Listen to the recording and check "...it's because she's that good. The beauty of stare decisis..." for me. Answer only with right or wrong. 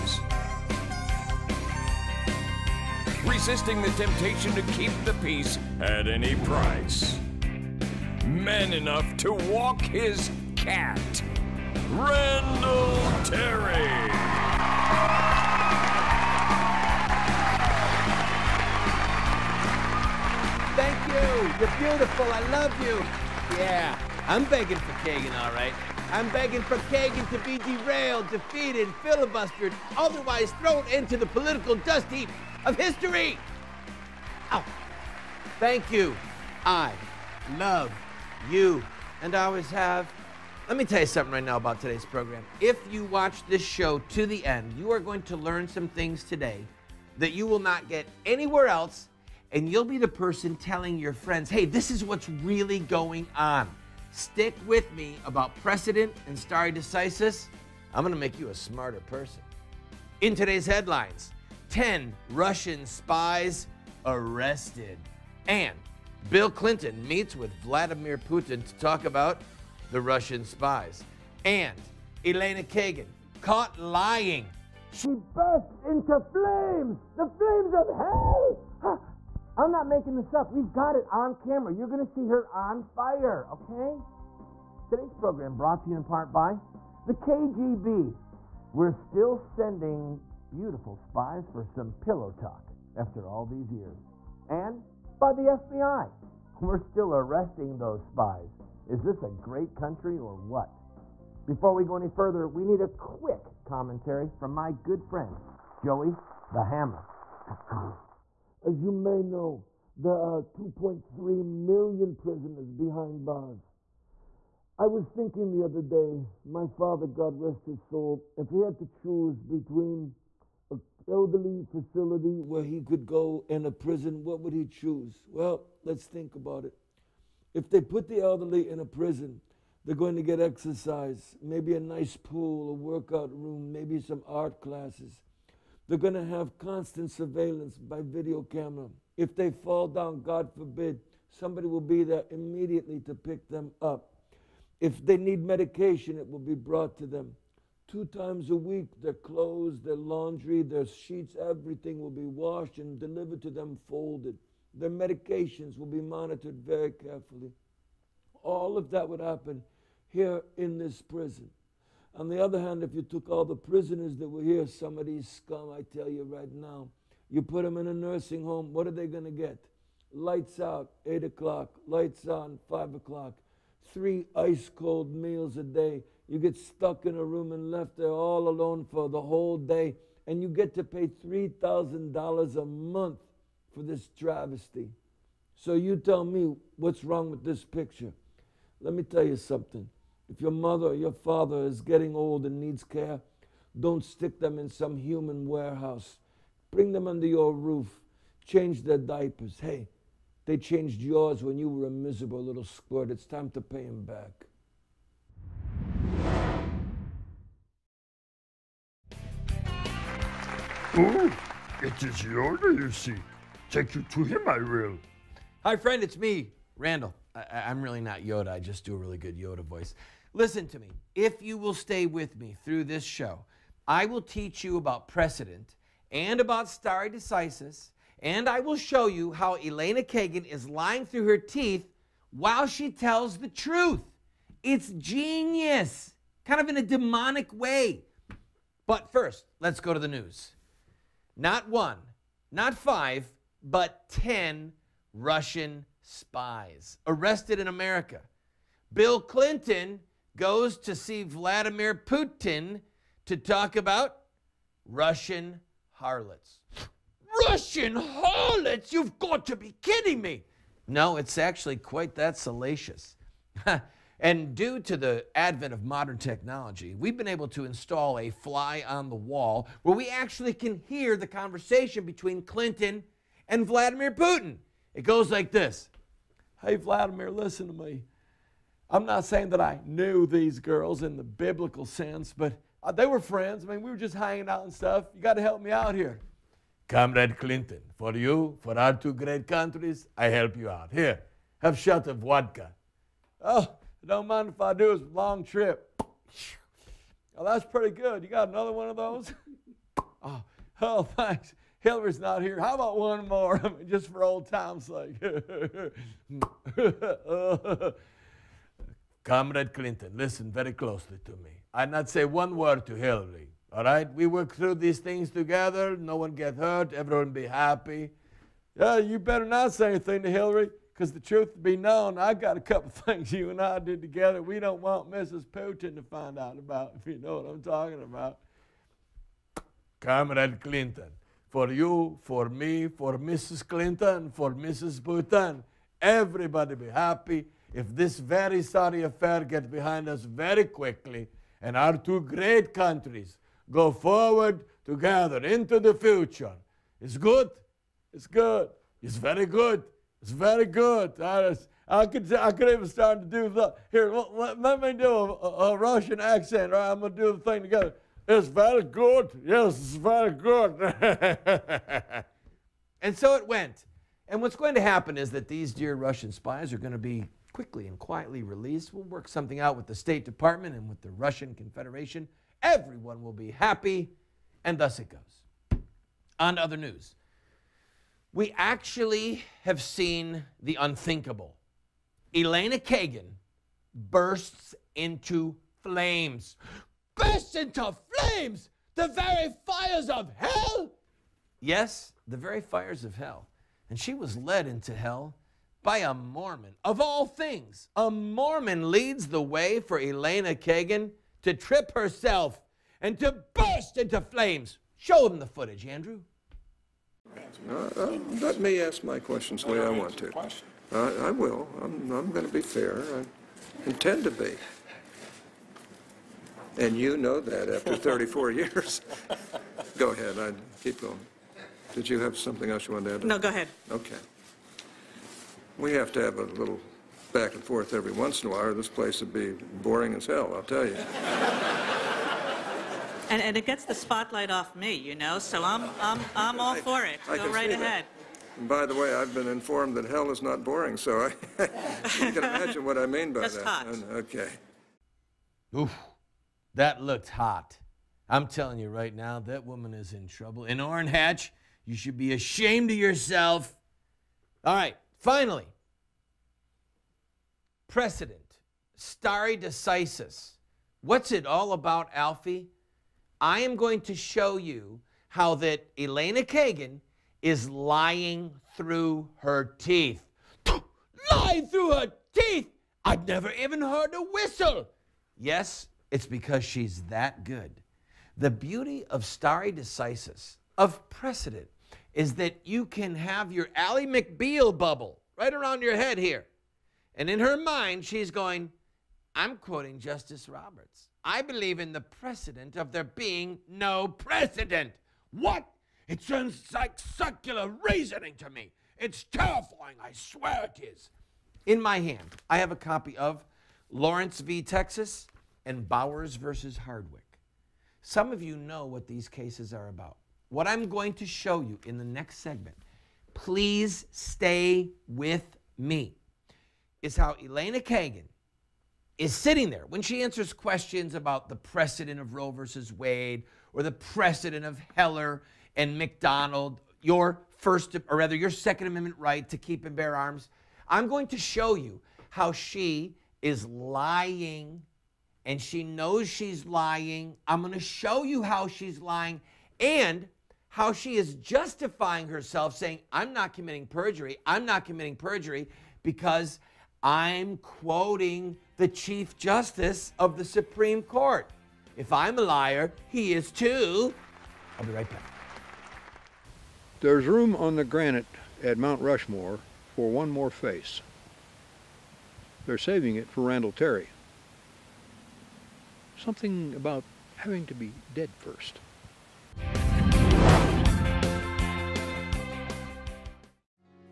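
right.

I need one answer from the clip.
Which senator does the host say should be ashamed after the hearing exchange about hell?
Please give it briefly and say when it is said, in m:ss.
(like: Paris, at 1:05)
Orrin Hatch, at 7:30.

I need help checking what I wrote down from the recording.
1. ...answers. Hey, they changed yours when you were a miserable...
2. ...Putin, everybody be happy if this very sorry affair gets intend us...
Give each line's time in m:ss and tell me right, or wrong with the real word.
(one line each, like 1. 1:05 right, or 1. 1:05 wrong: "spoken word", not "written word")
1. 3:18 wrong: "diapers", not "answers"
2. 5:34 wrong: "behind", not "intend".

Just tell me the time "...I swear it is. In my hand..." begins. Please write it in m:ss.
8:20.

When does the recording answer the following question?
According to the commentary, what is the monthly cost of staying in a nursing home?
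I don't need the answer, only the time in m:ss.
3:01.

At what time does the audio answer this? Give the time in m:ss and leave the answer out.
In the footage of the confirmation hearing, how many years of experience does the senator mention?
6:57.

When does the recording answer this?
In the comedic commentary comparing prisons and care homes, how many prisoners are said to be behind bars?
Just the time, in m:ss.
1:50.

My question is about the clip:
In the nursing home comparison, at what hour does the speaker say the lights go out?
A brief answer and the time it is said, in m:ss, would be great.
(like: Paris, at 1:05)
8 o'clock, at 2:51.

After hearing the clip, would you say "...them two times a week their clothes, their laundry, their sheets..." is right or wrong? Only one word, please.
right.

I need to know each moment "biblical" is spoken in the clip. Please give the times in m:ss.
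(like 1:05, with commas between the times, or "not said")
4:41.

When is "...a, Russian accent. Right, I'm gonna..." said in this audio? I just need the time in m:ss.
5:55.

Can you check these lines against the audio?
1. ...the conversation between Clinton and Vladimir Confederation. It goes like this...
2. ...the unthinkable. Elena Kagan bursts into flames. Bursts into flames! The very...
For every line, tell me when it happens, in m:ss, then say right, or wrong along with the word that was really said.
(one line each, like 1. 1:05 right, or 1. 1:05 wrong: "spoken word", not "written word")
1. 4:31 wrong: "Putin", not "Confederation"
2. 6:20 right.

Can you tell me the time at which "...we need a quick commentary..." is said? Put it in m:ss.
1:42.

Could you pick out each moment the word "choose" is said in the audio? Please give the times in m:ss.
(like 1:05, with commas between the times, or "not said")
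1:58, 2:04.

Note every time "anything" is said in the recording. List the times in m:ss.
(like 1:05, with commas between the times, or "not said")
5:19.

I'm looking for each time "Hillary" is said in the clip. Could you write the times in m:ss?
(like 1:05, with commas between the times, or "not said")
5:01, 5:12, 5:20.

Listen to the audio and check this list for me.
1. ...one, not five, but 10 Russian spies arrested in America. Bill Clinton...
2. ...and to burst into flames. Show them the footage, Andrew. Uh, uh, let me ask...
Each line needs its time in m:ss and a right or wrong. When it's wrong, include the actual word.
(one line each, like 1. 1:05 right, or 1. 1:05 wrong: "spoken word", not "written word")
1. 4:01 right
2. 6:43 right.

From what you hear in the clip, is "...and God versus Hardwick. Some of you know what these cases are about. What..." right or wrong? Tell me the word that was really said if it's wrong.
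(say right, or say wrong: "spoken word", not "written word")
wrong: "Bowers", not "God".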